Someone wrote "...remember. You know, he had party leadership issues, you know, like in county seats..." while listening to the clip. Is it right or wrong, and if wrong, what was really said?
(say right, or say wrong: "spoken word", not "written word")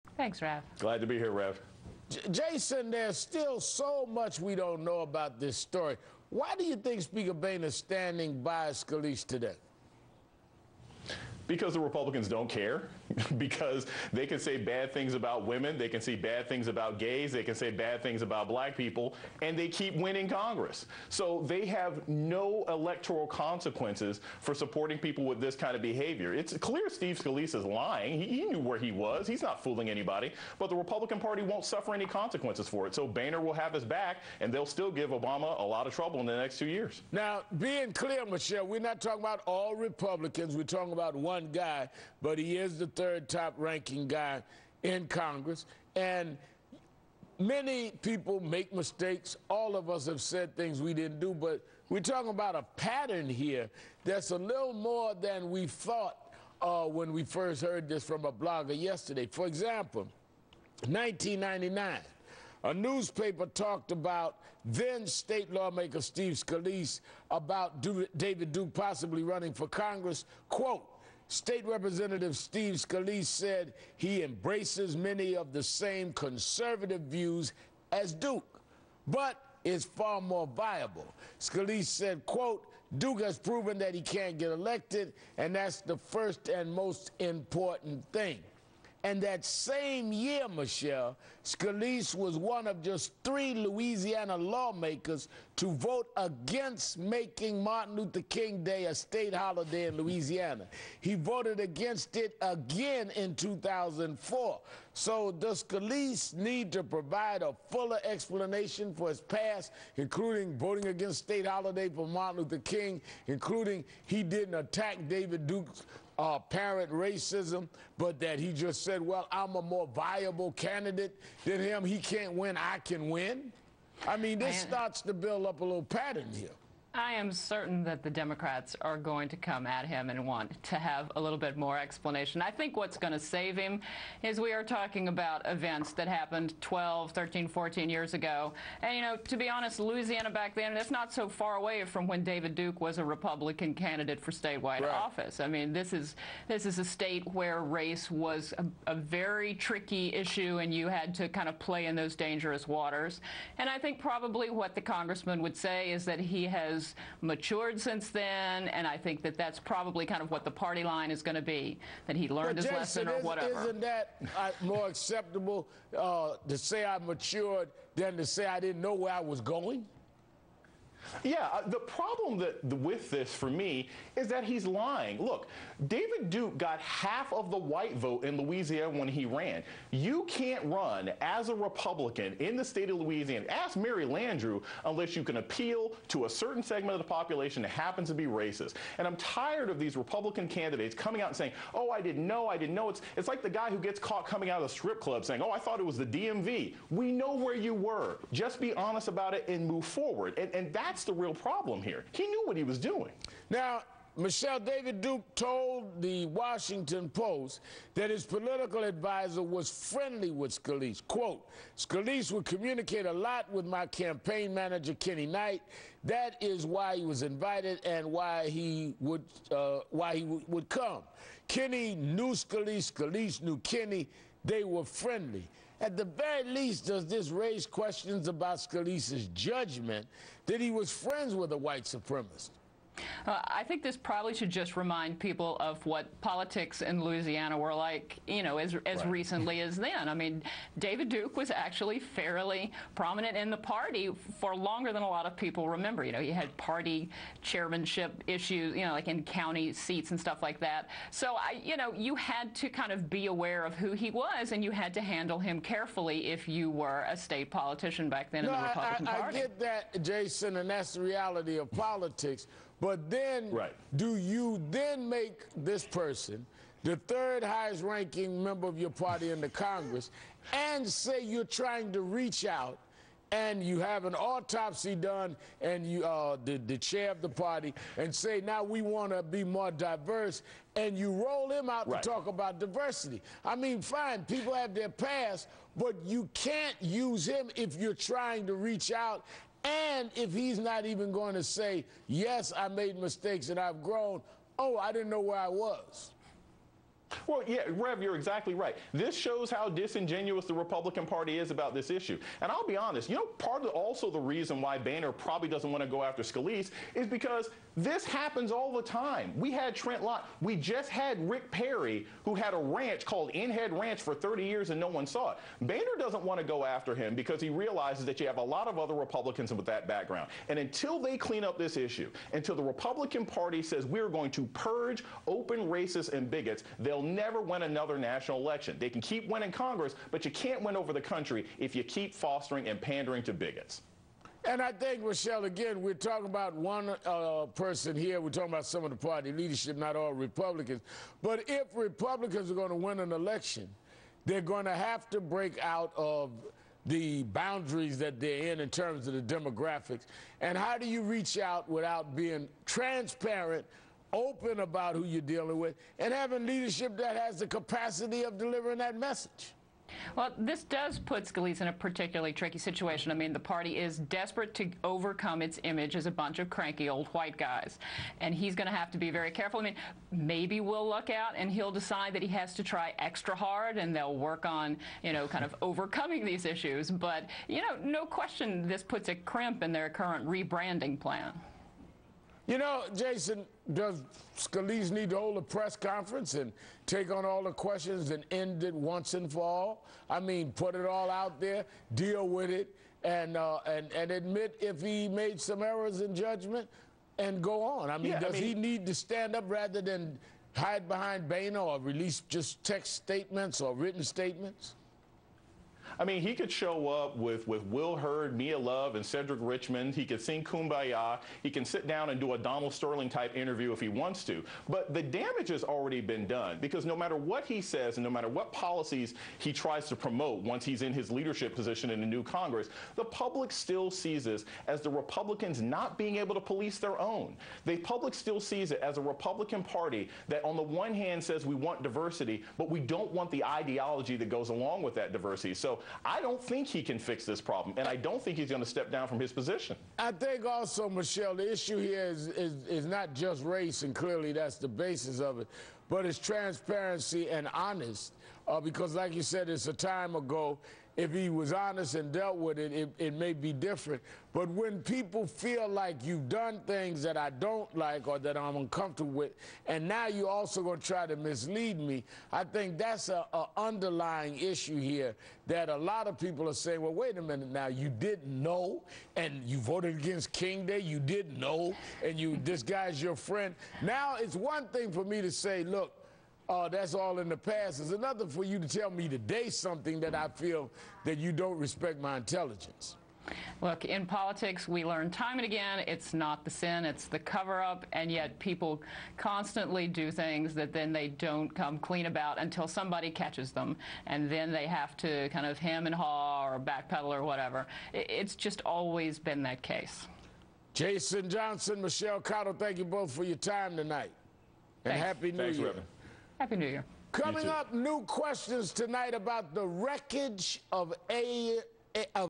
wrong: "chairmanship", not "leadership".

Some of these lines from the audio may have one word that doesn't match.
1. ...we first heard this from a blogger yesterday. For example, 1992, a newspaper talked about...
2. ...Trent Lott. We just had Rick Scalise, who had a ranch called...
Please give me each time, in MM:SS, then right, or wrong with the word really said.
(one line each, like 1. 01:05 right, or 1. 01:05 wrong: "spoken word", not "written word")
1. 00:57 wrong: "1999", not "1992"
2. 05:09 wrong: "Perry", not "Scalise".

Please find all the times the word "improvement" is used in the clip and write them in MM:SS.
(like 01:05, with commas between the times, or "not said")
not said.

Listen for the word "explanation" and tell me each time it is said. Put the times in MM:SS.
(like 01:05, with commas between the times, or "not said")
01:48, 02:11.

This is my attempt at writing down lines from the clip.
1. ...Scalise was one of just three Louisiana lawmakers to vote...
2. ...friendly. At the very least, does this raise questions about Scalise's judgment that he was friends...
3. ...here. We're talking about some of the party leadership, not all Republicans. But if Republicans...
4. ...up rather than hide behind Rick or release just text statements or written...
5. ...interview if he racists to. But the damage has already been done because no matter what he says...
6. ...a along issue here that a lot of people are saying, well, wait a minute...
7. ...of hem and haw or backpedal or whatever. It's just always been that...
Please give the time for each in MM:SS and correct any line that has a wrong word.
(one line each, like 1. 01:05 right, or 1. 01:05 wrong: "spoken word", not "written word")
1. 01:31 right
2. 03:44 right
3. 05:37 right
4. 06:39 wrong: "Boehner", not "Rick"
5. 06:53 wrong: "wants", not "racists"
6. 07:43 wrong: "underlying", not "along"
7. 08:15 right.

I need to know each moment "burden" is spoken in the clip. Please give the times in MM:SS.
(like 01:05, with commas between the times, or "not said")
not said.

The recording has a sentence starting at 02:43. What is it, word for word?
Isn't that uh, more acceptable uh, to say I matured than to say I didn't know where I was going?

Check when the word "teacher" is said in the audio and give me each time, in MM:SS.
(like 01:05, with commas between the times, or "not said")
not said.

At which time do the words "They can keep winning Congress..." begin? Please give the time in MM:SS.
05:28.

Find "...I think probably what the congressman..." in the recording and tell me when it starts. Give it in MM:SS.
02:33.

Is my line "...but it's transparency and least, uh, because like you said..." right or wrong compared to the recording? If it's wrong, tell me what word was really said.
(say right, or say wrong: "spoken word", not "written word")
wrong: "honest", not "least".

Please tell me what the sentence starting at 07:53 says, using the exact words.
Now it's one thing for me to say, look, uh, that's all in the past.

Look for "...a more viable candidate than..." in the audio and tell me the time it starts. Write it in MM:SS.
01:59.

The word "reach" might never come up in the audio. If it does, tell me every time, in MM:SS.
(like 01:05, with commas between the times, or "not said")
04:32, 04:48, 05:51.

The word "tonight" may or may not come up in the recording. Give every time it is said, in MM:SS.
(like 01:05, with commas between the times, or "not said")
08:23, 08:28.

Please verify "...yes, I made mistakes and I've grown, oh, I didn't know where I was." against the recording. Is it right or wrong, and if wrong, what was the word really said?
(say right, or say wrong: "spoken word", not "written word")
right.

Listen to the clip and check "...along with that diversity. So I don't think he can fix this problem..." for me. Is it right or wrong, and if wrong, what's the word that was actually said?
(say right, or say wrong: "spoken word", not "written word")
right.